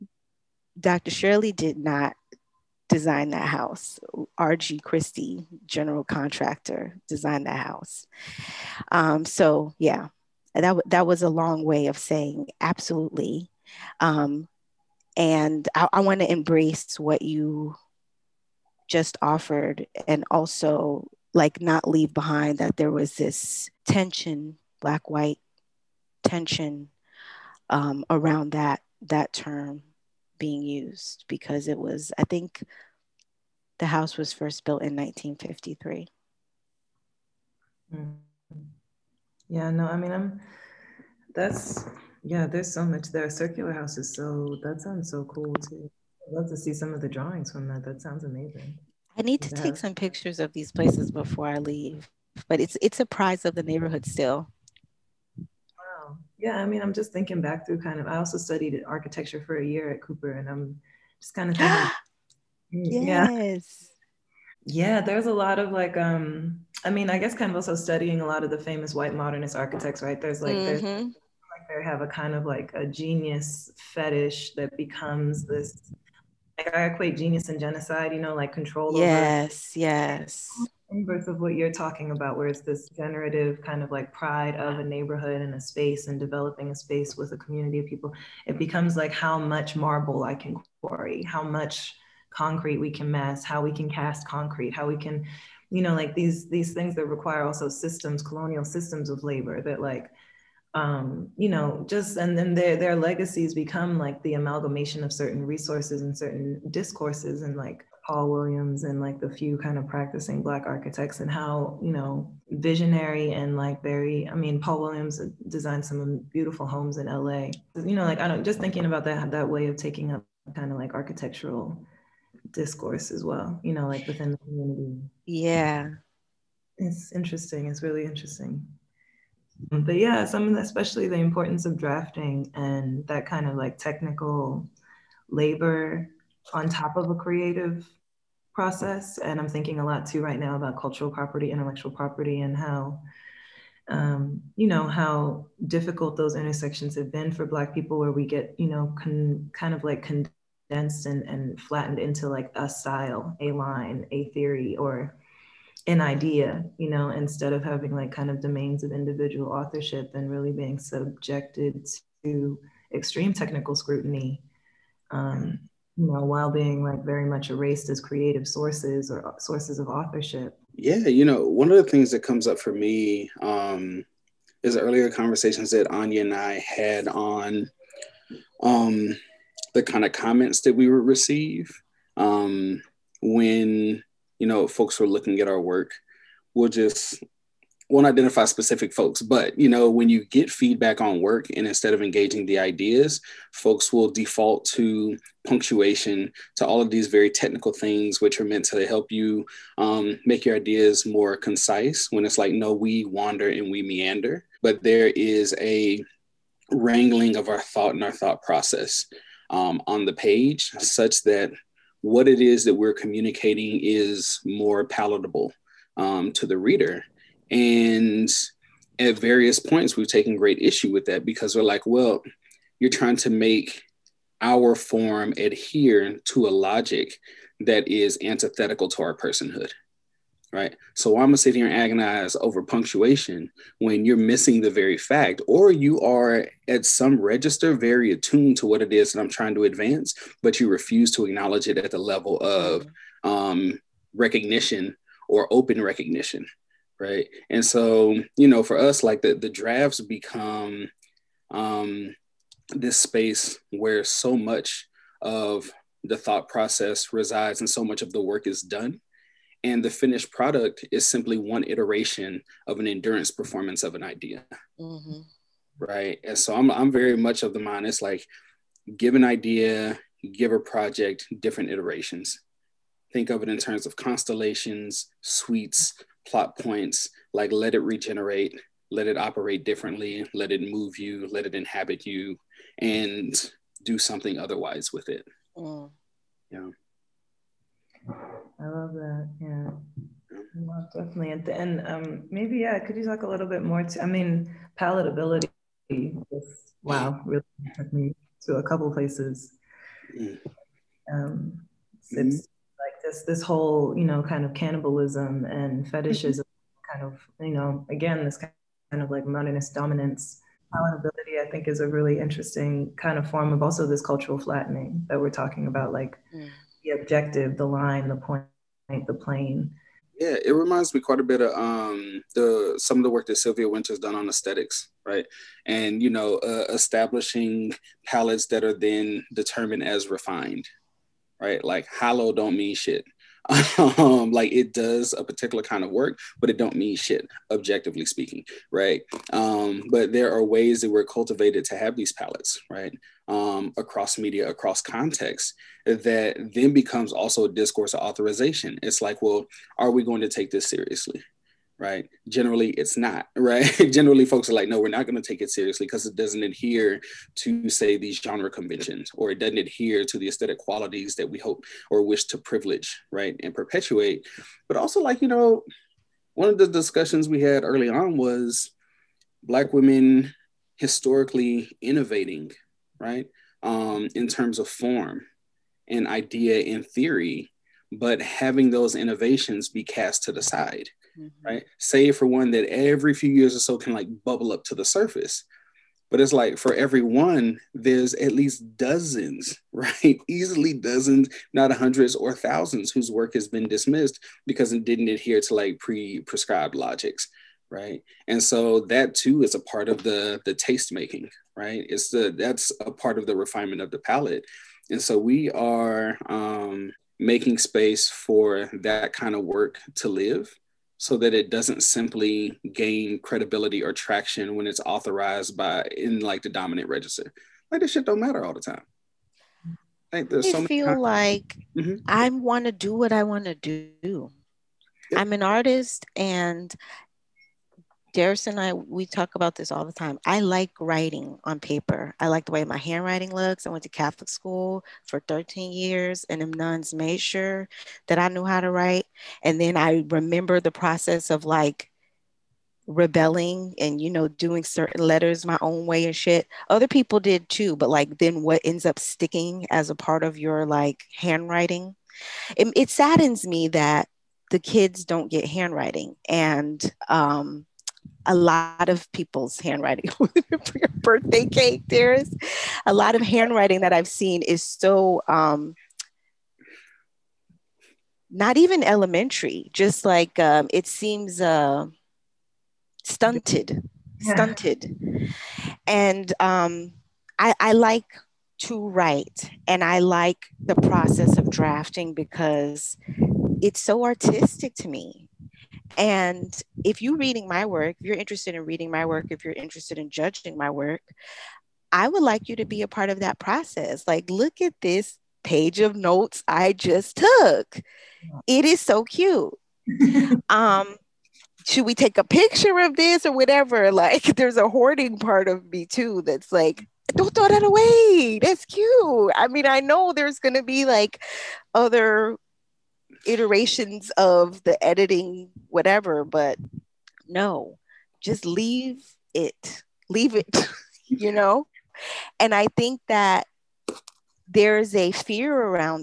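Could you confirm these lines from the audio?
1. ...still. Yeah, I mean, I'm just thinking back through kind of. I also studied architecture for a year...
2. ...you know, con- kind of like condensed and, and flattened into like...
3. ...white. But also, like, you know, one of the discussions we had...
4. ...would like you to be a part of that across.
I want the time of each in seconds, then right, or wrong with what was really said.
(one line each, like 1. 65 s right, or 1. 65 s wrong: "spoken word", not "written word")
1. 54 s right
2. 148 s right
3. 363 s wrong: "perpetuate", not "white"
4. 492 s wrong: "process", not "across".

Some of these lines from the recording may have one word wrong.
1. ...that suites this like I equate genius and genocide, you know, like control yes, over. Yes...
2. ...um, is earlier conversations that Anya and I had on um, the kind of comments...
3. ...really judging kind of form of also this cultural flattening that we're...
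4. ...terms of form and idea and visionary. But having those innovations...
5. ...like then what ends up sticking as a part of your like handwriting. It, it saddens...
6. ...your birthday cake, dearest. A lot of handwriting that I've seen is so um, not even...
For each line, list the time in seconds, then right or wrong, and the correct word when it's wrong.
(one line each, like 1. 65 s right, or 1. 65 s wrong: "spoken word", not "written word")
1. 74 s wrong: "becomes", not "suites"
2. 173 s right
3. 311 s wrong: "interesting", not "judging"
4. 374 s wrong: "theory", not "visionary"
5. 447 s right
6. 460 s right.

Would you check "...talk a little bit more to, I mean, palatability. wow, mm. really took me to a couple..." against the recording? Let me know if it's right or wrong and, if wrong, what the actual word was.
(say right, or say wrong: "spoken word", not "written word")
right.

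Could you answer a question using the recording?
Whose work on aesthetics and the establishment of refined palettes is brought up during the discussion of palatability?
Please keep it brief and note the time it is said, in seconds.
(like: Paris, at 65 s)
Sylvia Wynter, at 323 s.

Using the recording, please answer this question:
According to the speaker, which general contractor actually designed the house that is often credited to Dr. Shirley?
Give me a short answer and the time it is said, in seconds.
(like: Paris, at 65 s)
R.G. Christie, at 4 s.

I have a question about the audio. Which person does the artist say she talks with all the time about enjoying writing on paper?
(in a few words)
Derrais.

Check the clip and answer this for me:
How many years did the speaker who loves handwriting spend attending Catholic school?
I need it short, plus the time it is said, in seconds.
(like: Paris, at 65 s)
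13, at 435 s.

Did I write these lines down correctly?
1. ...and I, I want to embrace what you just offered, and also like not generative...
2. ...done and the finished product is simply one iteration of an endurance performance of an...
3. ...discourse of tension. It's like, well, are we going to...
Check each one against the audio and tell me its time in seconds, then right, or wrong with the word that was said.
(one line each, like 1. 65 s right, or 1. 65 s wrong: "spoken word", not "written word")
1. 15 s wrong: "leave", not "generative"
2. 258 s right
3. 347 s wrong: "authorization", not "tension".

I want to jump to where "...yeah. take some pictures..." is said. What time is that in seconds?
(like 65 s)
49 s.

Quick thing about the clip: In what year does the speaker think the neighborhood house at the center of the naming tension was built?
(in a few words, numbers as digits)
1953.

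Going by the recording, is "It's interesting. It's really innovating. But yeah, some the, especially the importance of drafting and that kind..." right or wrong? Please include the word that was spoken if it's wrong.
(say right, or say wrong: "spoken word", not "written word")
wrong: "interesting", not "innovating".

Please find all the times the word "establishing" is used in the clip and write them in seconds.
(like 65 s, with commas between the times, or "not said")
326 s.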